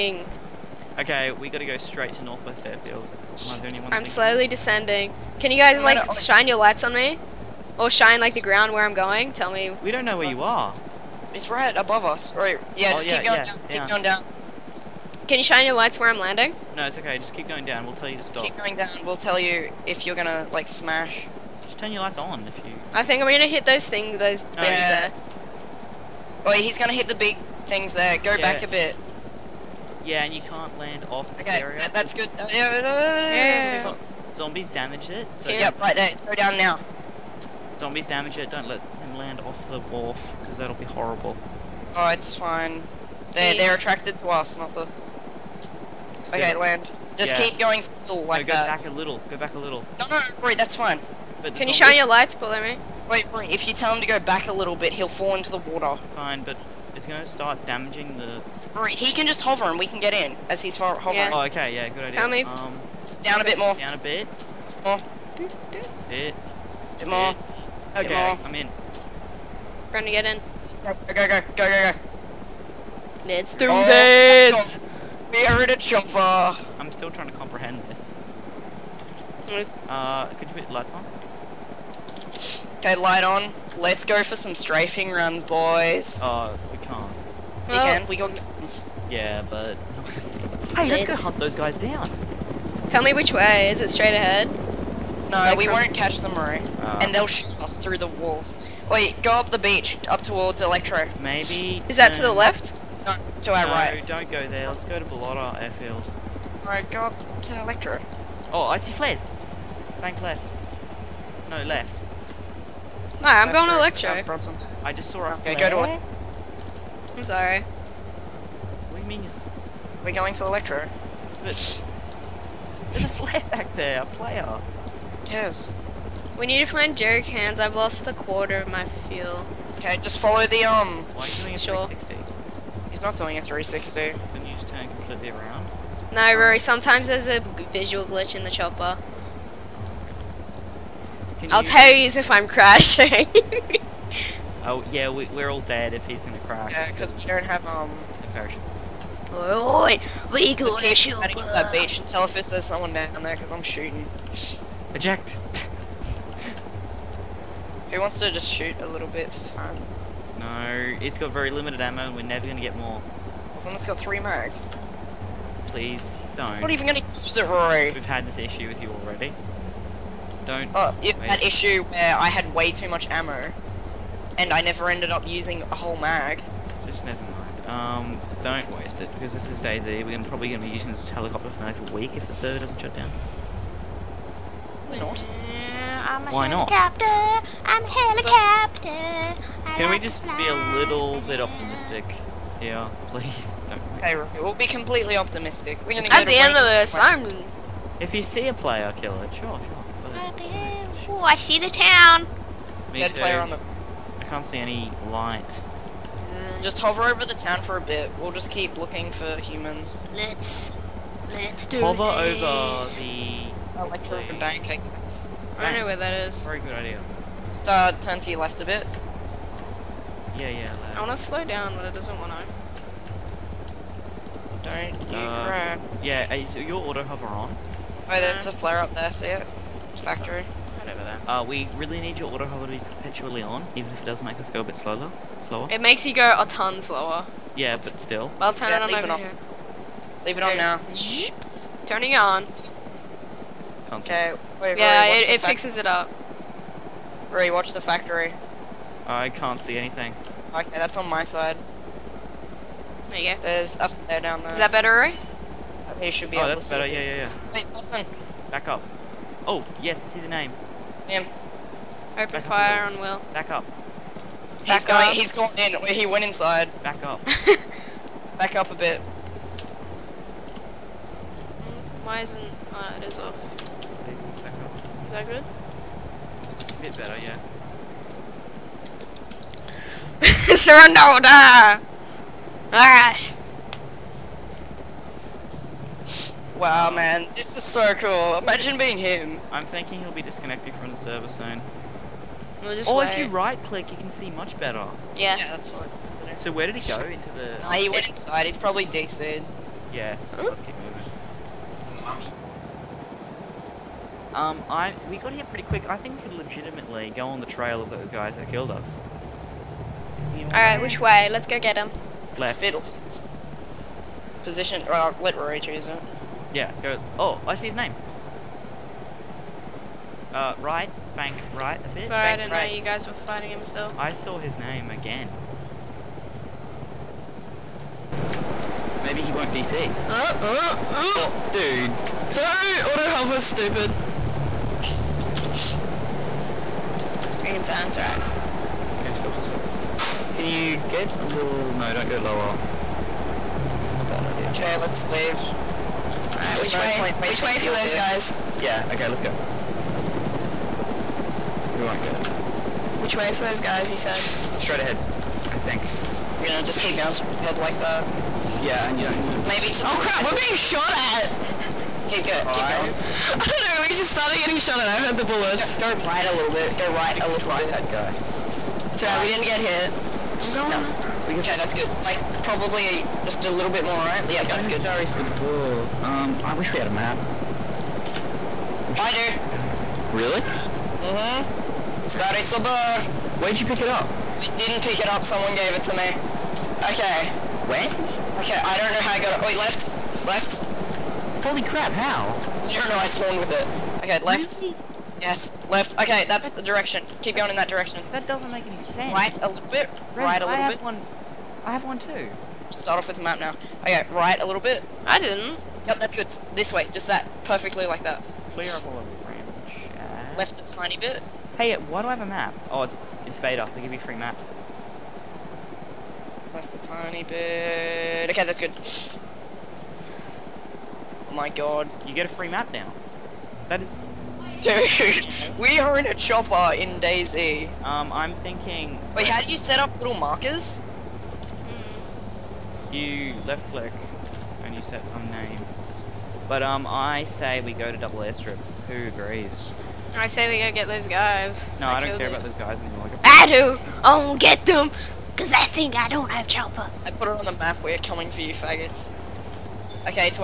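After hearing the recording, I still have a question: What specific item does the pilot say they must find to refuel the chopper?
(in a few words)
Jerry cans.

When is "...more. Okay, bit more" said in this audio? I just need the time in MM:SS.
01:07.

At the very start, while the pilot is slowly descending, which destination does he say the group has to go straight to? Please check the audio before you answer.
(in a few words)
Northwest Airfield.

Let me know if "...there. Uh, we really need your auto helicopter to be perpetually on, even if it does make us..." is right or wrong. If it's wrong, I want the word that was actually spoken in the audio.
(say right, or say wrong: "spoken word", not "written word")
wrong: "hover", not "helicopter".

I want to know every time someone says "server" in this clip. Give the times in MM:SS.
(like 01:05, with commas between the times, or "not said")
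03:02, 04:50.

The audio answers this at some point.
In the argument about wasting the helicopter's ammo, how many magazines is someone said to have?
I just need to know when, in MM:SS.
02:43.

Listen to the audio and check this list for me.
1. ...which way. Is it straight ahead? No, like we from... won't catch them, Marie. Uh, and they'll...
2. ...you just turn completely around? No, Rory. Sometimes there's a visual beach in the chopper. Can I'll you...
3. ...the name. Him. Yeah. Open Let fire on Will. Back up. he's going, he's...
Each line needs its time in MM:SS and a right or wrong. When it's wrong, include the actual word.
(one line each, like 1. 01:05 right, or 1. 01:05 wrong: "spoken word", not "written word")
1. 01:33 right
2. 02:14 wrong: "glitch", not "beach"
3. 04:20 wrong: "Back", not "Let".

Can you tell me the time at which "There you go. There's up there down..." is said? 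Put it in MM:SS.
04:13.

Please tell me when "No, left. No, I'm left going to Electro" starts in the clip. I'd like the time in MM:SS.
01:51.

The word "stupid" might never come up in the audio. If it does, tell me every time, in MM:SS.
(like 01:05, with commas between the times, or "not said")
05:33.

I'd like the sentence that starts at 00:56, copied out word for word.
Fine, but it's gonna start damaging the...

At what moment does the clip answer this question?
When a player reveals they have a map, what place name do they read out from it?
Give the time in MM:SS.
06:22.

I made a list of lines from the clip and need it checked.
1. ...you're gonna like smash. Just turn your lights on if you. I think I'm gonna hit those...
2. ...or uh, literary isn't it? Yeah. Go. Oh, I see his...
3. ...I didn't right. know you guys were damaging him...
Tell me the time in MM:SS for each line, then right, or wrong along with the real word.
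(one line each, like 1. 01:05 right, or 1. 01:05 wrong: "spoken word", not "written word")
1. 00:20 right
2. 05:14 right
3. 05:22 wrong: "fighting", not "damaging".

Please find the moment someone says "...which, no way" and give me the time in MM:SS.
05:46.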